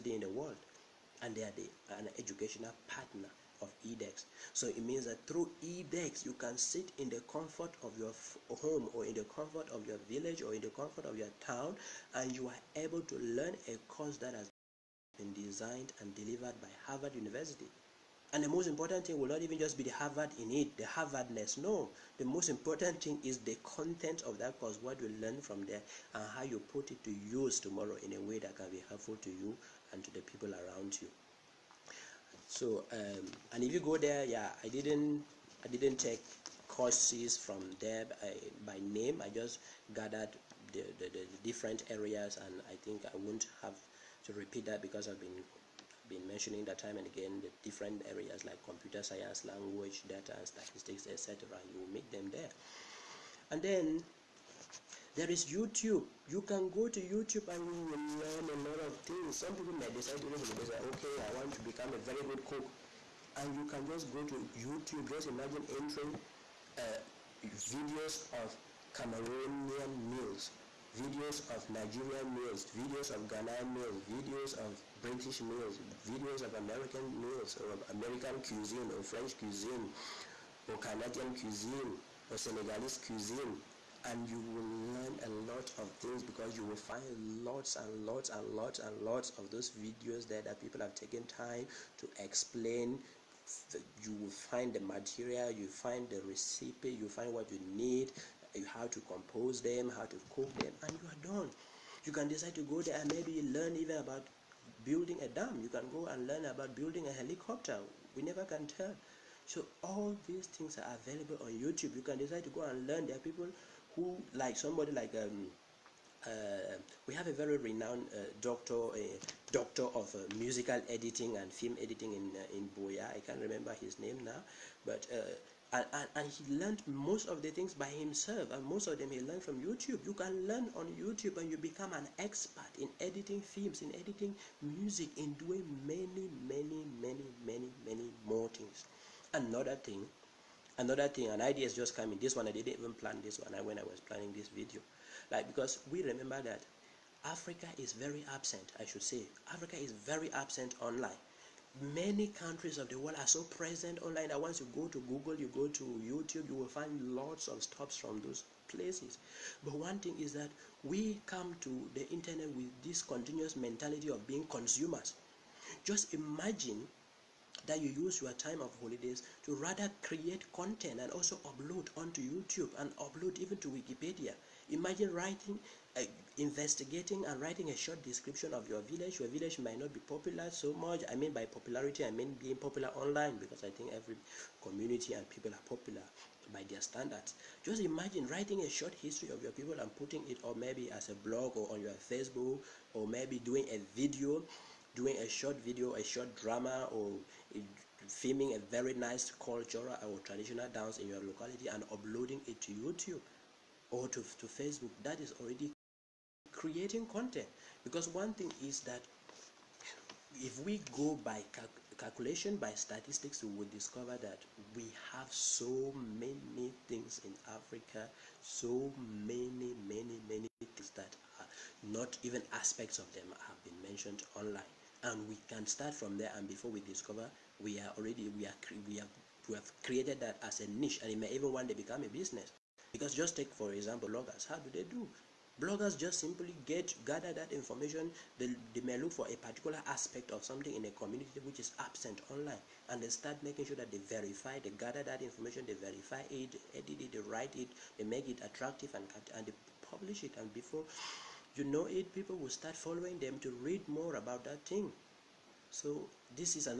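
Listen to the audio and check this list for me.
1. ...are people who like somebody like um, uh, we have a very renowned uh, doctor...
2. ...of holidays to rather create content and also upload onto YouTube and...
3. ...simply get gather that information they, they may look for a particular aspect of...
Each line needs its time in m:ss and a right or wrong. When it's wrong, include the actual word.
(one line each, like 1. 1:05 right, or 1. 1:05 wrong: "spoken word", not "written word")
1. 1:53 right
2. 2:48 right
3. 3:56 right.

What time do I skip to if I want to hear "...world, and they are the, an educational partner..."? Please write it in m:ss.
0:00.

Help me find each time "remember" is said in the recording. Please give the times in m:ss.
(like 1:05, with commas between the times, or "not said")
2:03, 2:26.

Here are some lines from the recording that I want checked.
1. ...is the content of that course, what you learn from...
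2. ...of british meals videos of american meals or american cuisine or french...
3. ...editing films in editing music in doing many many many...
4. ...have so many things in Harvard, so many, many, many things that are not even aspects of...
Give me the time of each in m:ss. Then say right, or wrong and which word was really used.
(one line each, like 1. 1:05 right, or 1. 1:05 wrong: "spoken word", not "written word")
1. 0:23 right
2. 1:14 right
3. 2:12 right
4. 3:35 wrong: "Africa", not "Harvard".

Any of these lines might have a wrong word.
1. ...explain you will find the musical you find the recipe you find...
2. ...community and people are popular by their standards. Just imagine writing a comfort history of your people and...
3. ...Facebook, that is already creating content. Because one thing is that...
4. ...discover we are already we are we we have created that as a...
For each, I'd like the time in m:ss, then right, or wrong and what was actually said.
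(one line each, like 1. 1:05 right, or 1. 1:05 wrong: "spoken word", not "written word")
1. 1:32 wrong: "material", not "musical"
2. 3:04 wrong: "short", not "comfort"
3. 3:24 right
4. 3:46 right.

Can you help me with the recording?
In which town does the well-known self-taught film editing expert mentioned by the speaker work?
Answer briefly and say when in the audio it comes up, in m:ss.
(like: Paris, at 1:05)
Buea, at 2:02.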